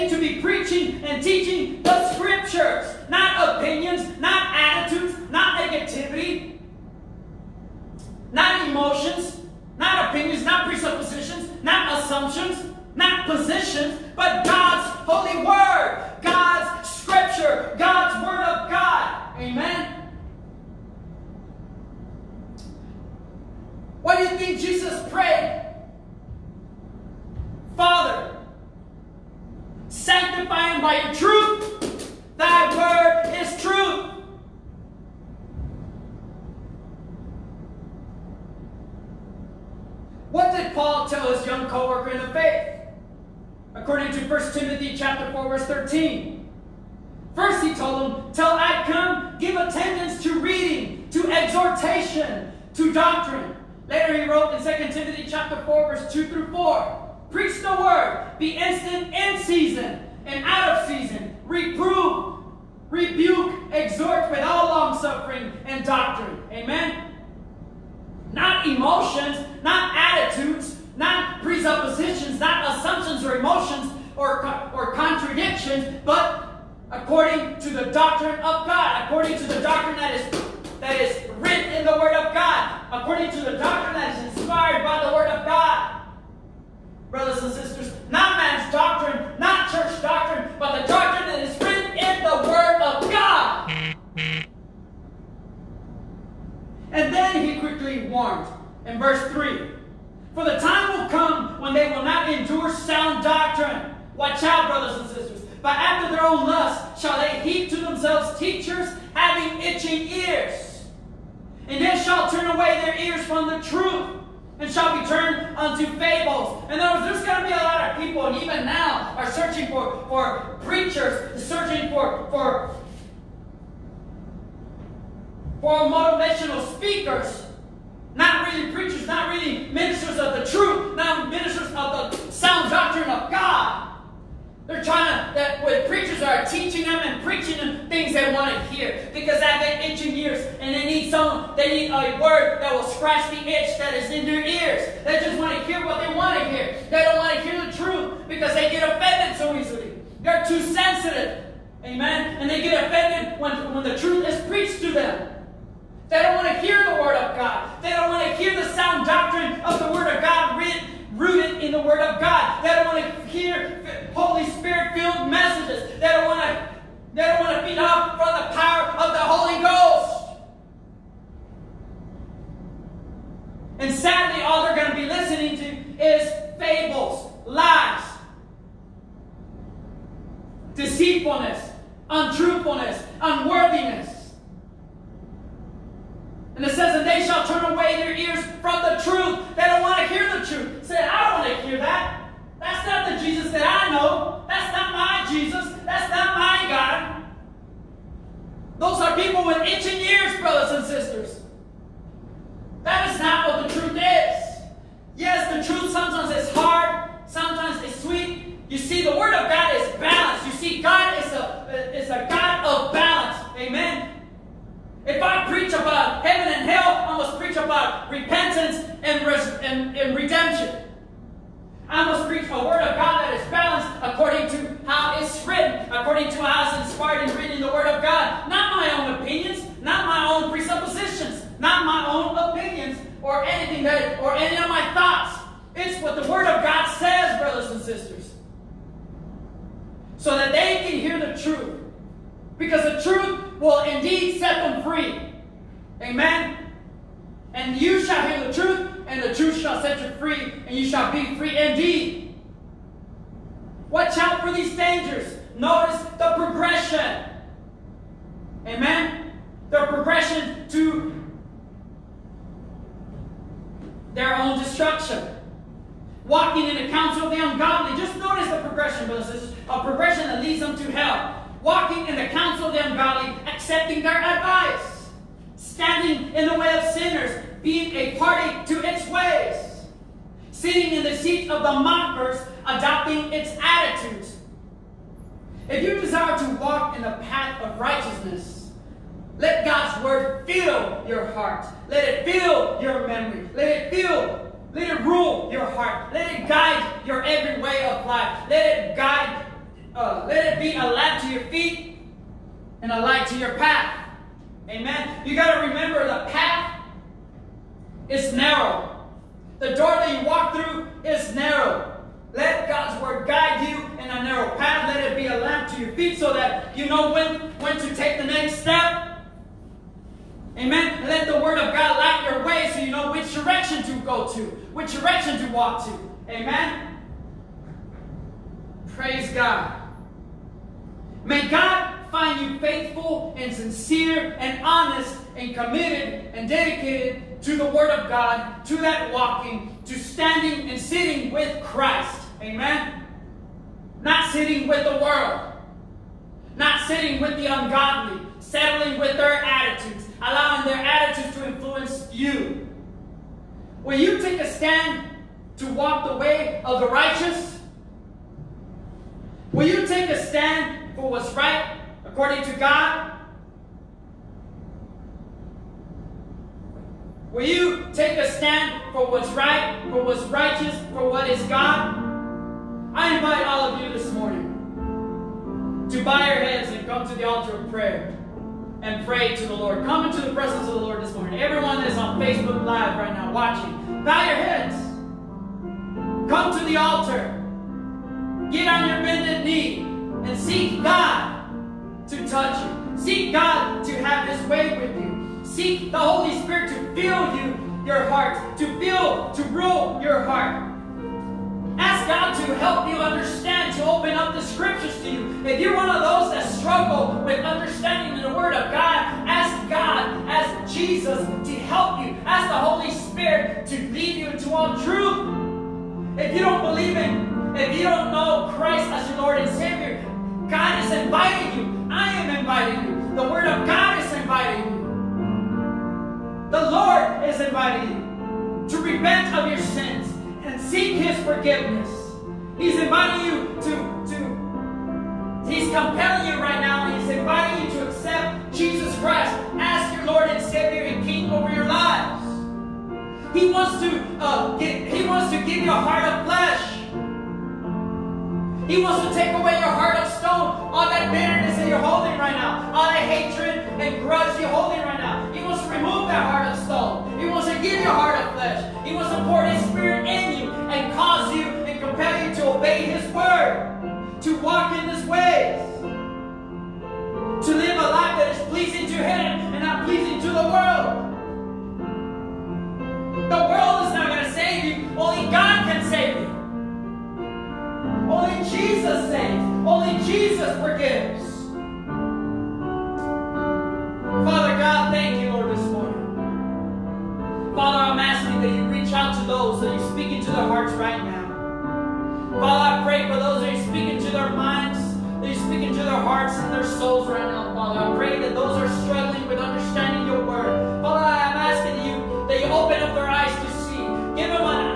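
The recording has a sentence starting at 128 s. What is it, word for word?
Not really preachers, not really ministers of the truth, not ministers of the sound doctrine of God.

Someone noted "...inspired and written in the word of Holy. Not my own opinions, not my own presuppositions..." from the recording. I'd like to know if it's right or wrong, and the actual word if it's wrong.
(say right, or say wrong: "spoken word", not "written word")
wrong: "God", not "Holy".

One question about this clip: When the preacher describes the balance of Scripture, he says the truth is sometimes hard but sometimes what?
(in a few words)
sweet.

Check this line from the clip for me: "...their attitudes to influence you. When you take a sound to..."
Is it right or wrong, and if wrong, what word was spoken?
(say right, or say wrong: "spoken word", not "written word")
wrong: "stand", not "sound".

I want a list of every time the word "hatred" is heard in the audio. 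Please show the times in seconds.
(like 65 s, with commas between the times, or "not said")
453 s.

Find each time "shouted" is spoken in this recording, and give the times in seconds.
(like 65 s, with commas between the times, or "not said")
not said.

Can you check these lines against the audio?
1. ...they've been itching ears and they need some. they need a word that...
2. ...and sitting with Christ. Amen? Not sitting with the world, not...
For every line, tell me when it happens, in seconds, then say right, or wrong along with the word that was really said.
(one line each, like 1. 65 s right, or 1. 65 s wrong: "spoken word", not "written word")
1. 139 s right
2. 340 s right.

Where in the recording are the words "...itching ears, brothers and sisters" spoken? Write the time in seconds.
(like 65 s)
199 s.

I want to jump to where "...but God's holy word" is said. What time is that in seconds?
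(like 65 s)
14 s.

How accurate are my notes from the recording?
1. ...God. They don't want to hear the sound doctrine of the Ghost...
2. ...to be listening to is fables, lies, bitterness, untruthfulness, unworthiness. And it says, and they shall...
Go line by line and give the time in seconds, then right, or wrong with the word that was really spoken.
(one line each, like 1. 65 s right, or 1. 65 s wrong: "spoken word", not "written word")
1. 157 s wrong: "Word", not "Ghost"
2. 174 s wrong: "deceitfulness", not "bitterness".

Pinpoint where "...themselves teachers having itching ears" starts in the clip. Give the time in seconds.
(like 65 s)
107 s.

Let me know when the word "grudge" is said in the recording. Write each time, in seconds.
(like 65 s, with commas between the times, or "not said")
454 s.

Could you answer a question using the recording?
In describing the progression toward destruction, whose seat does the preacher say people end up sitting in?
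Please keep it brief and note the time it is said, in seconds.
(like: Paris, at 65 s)
the mockers, at 281 s.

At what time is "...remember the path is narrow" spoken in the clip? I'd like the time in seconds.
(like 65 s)
305 s.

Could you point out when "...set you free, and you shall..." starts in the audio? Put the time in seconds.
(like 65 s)
249 s.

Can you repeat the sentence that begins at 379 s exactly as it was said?
Come into the presence of the Lord this morning.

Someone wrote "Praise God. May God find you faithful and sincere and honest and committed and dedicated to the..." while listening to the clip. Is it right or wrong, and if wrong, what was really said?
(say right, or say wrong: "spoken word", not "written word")
right.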